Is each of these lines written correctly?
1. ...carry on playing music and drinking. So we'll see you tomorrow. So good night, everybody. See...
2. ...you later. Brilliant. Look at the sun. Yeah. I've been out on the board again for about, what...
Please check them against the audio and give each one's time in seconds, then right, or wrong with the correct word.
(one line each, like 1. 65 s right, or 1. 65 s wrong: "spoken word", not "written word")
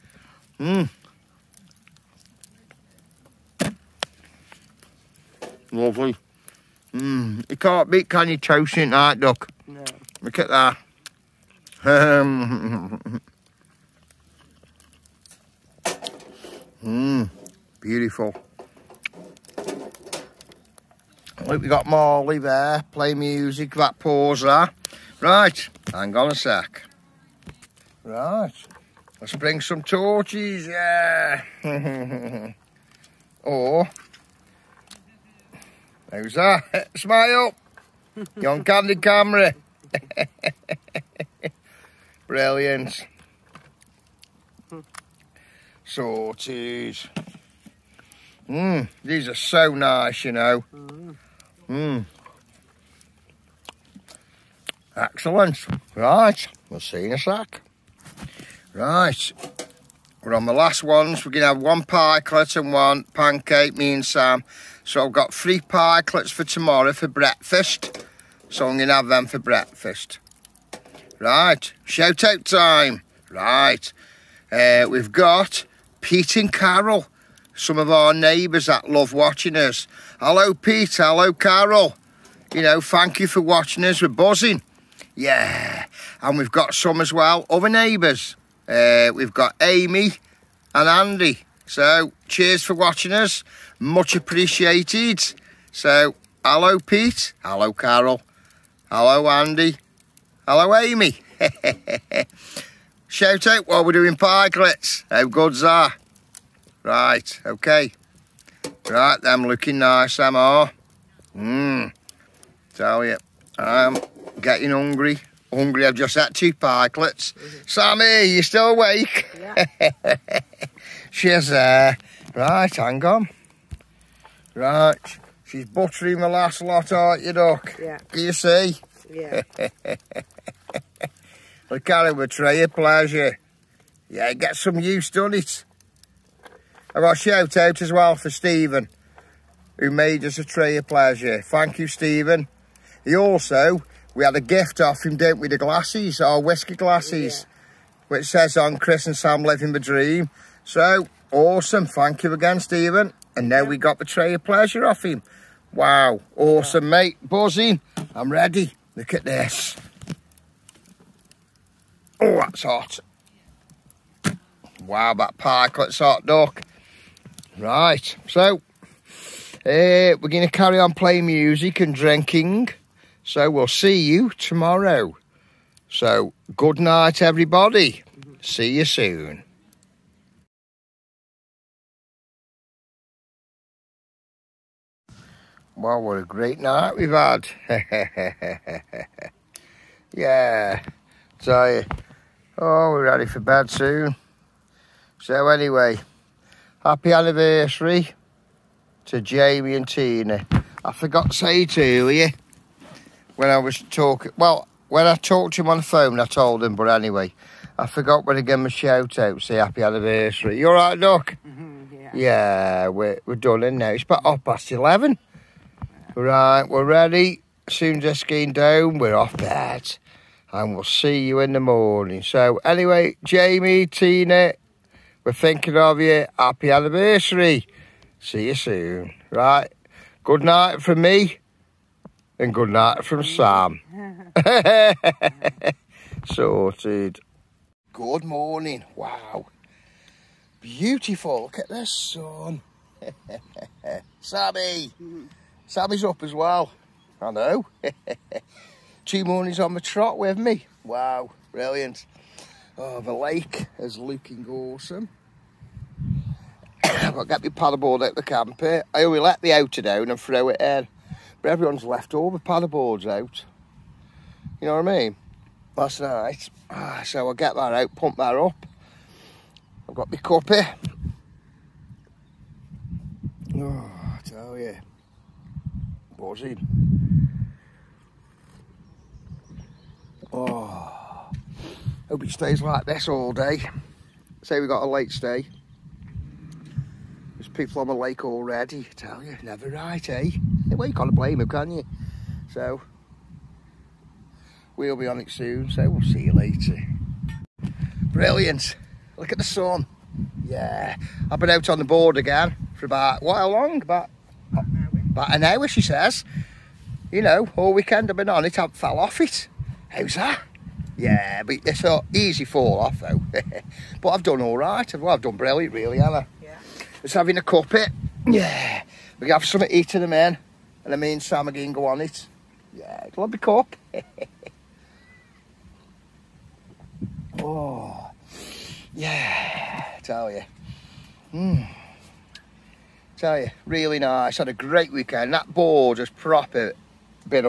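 1. 170 s right
2. 296 s right.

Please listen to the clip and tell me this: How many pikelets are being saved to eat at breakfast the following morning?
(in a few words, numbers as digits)
3.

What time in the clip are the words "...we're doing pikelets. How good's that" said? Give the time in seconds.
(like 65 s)
103 s.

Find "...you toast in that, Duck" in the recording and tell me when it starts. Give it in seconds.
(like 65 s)
8 s.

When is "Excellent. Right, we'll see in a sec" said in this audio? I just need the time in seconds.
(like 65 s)
54 s.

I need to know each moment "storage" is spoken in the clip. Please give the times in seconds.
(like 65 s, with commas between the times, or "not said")
not said.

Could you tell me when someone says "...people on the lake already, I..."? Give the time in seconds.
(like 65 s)
287 s.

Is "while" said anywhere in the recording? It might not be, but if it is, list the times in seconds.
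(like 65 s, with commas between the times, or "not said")
103 s.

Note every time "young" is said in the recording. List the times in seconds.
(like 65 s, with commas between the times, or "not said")
38 s.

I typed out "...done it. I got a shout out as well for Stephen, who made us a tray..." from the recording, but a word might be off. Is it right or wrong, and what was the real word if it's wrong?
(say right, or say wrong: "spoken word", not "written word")
right.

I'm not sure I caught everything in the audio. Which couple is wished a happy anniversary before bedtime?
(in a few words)
Jamie and Tina.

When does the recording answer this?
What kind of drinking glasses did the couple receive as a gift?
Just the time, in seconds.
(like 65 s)
146 s.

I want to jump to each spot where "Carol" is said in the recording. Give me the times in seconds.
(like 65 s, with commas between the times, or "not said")
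76 s, 81 s, 97 s.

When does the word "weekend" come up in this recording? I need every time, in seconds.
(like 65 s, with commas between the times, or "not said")
307 s, 334 s.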